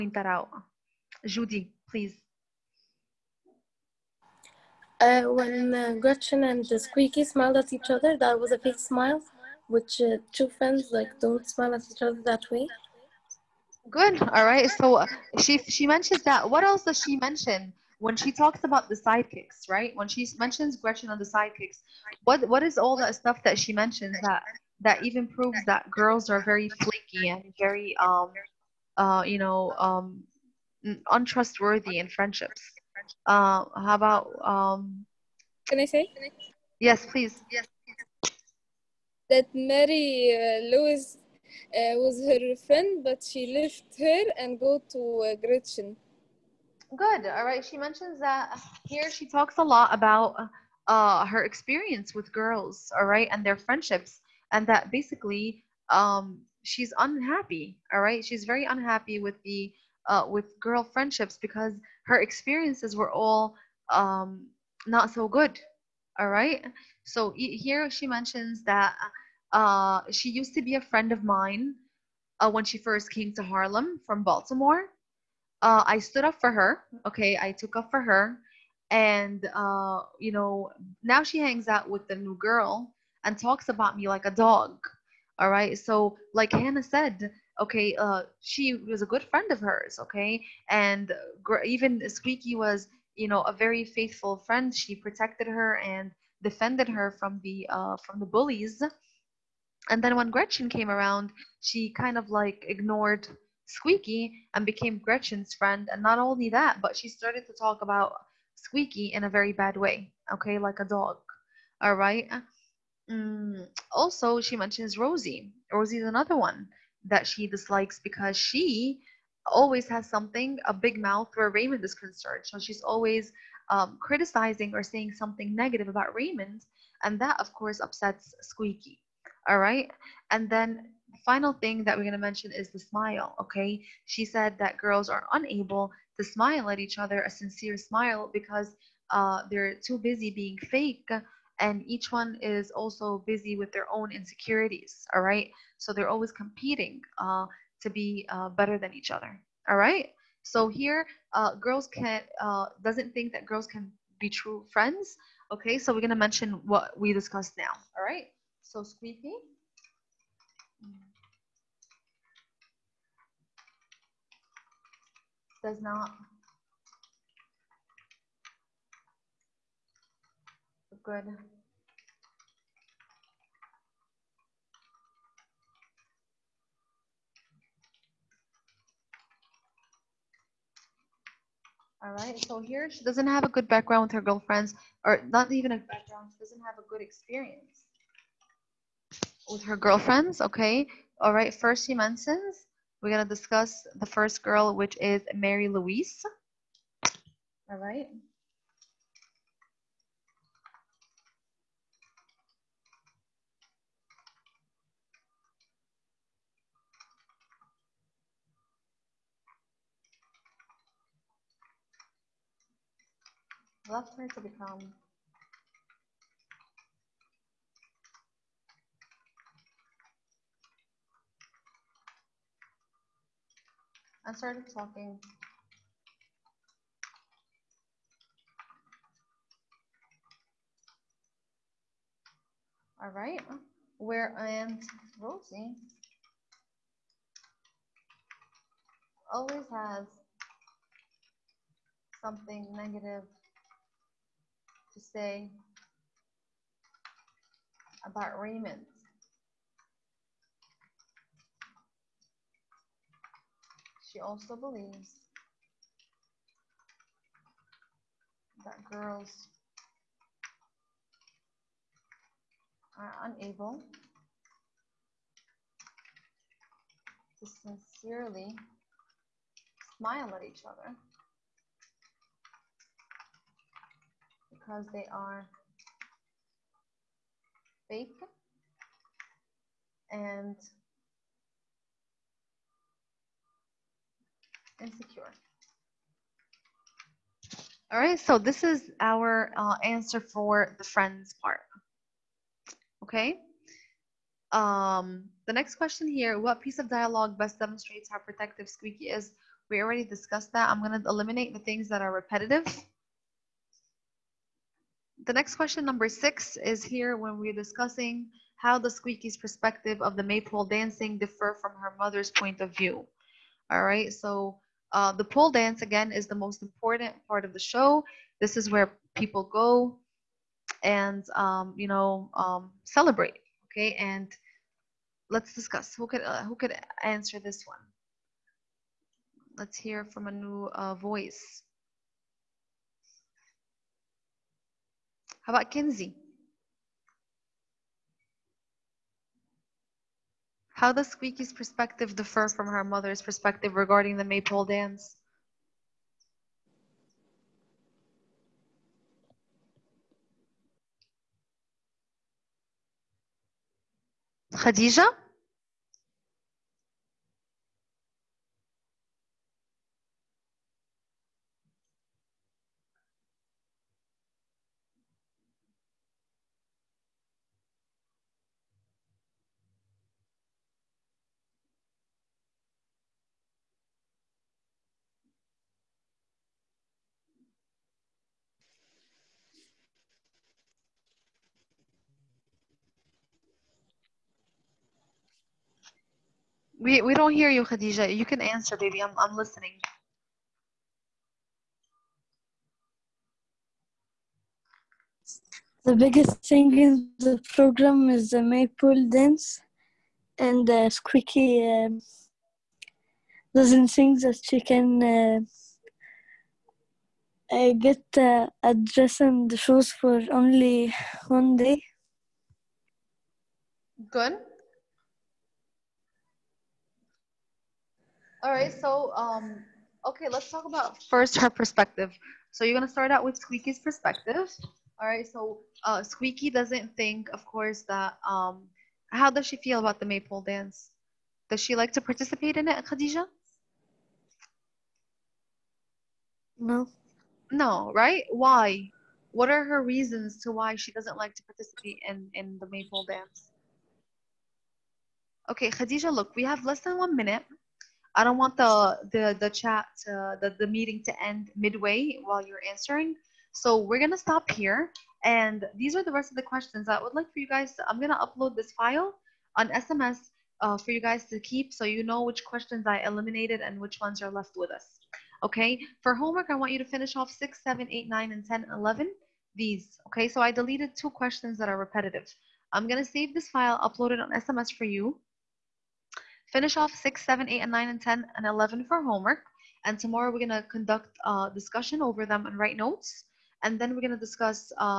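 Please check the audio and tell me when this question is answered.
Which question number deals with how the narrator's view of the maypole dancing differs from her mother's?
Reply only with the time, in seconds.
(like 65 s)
305 s.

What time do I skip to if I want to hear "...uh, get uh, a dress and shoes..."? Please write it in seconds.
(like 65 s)
407 s.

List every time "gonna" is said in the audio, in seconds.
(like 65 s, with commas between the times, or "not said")
193 s, 422 s, 453 s, 457 s, 472 s.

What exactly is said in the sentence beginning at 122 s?
So she's always um, criticizing or saying something negative about Raymond.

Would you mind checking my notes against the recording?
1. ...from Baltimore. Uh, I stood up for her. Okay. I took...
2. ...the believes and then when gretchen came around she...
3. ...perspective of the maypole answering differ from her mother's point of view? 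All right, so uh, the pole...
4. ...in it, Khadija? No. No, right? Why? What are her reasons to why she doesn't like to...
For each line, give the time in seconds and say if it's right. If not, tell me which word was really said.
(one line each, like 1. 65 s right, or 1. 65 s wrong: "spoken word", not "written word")
1. 74 s right
2. 98 s wrong: "bullies", not "believes"
3. 309 s wrong: "dancing", not "answering"
4. 432 s right.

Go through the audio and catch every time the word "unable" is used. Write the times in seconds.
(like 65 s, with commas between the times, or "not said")
135 s, 263 s.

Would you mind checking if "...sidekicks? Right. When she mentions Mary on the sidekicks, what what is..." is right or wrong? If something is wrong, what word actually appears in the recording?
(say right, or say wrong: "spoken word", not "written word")
wrong: "Gretchen", not "Mary".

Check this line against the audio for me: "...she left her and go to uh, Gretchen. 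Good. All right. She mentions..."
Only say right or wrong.
right.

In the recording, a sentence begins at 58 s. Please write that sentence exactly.
She's very unhappy with the uh, with girl friendships because her experiences were all um, not so good.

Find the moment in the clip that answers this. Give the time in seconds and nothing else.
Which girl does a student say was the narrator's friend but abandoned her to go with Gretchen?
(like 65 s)
39 s.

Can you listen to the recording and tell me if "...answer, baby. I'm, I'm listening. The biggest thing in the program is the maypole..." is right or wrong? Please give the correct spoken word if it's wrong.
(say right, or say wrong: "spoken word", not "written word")
right.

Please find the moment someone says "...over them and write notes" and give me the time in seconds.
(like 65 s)
482 s.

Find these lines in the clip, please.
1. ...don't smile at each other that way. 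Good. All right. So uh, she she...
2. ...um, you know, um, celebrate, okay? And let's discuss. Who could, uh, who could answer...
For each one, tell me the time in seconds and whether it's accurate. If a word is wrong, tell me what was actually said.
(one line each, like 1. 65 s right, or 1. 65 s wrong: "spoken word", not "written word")
1. 11 s right
2. 321 s right.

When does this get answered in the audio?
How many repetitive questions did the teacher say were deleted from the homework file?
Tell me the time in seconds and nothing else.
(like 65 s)
470 s.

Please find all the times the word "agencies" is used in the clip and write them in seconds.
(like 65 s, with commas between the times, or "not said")
not said.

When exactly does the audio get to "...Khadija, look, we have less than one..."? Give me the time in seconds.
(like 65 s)
445 s.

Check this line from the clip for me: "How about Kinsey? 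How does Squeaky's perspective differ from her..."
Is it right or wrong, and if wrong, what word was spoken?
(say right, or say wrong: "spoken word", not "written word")
right.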